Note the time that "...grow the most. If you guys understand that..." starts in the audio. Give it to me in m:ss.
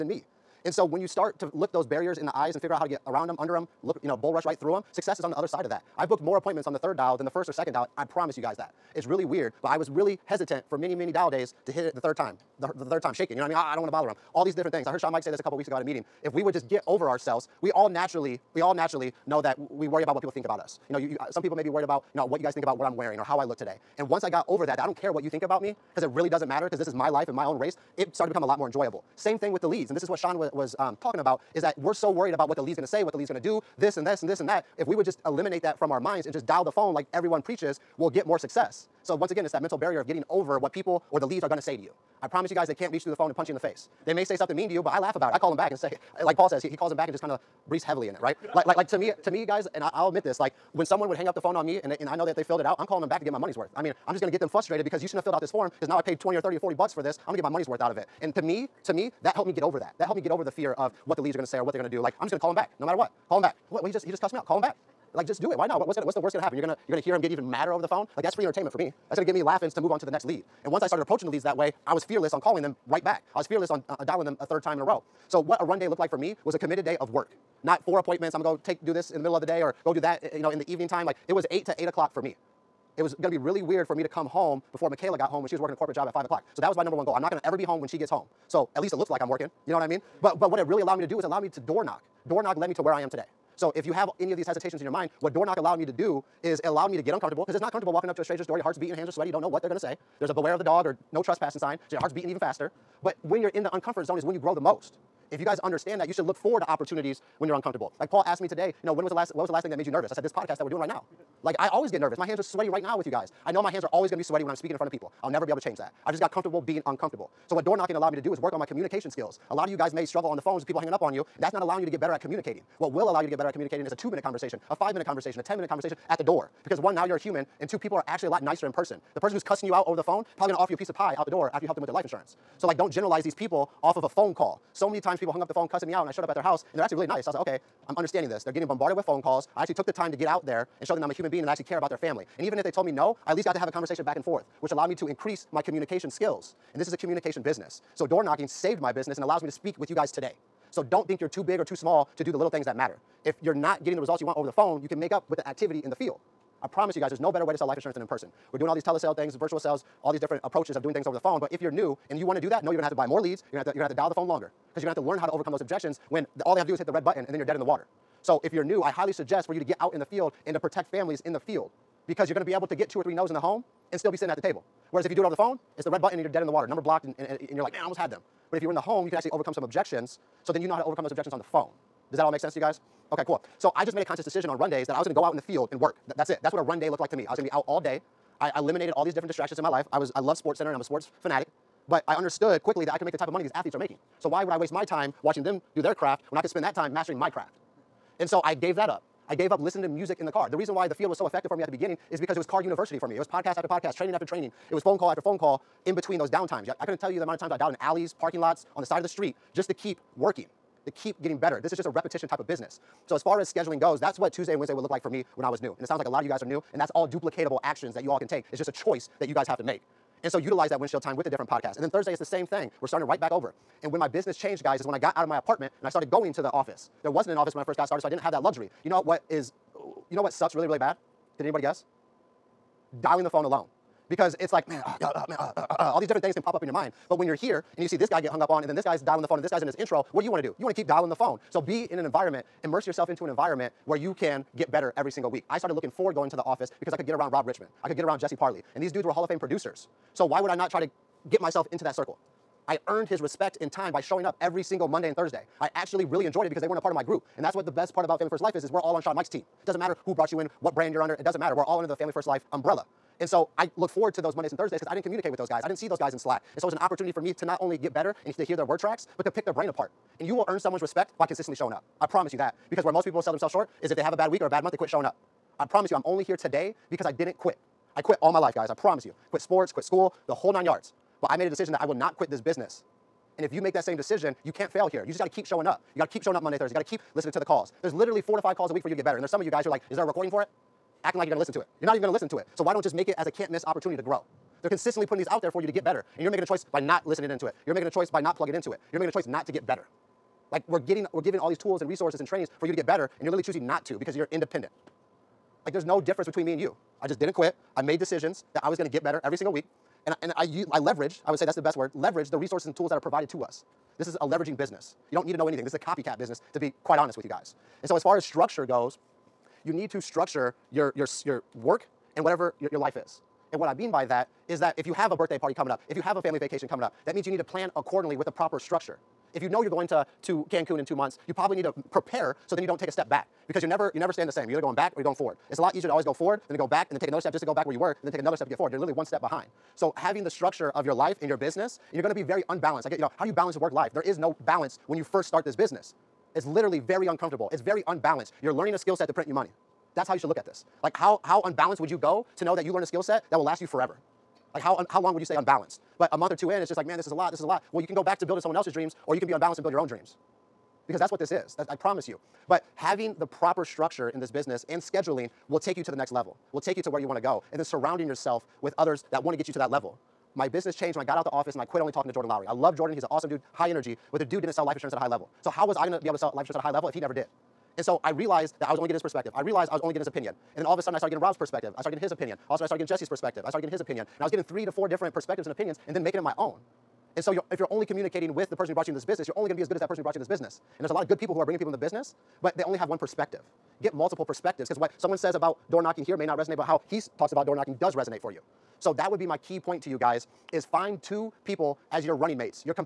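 1:44.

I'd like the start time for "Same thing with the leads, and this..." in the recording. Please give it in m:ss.
0:29.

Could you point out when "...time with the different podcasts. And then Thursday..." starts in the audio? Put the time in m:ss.
3:41.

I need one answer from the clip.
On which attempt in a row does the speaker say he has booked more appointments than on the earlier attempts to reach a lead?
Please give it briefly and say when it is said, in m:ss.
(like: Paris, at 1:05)
third dial, at 0:06.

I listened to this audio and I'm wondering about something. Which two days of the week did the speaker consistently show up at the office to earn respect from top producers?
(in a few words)
Monday and Thursday.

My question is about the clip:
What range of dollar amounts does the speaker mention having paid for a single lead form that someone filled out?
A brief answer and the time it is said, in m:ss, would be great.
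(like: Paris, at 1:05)
20 or 30 or 40 bucks, at 0:56.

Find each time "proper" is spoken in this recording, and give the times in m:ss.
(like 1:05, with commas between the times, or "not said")
5:28, 6:03.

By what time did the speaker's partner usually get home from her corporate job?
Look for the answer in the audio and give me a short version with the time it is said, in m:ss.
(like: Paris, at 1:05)
5 o'clock, at 1:26.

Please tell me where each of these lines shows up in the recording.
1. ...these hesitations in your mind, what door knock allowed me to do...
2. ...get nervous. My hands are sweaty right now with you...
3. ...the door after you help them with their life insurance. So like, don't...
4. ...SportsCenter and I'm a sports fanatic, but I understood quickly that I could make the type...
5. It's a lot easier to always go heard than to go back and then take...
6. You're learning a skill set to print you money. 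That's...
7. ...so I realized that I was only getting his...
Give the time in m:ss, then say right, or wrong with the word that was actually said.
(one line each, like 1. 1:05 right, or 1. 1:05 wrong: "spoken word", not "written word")
1. 1:34 right
2. 1:51 right
3. 2:11 right
4. 3:10 right
5. 5:35 wrong: "forward", not "heard"
6. 5:48 right
7. 6:17 right.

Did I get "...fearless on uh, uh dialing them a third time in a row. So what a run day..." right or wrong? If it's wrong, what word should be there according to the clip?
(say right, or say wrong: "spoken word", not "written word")
right.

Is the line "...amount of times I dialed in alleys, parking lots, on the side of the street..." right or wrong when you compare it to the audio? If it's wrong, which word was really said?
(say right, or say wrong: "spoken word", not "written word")
right.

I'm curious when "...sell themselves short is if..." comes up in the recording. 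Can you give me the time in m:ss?
4:33.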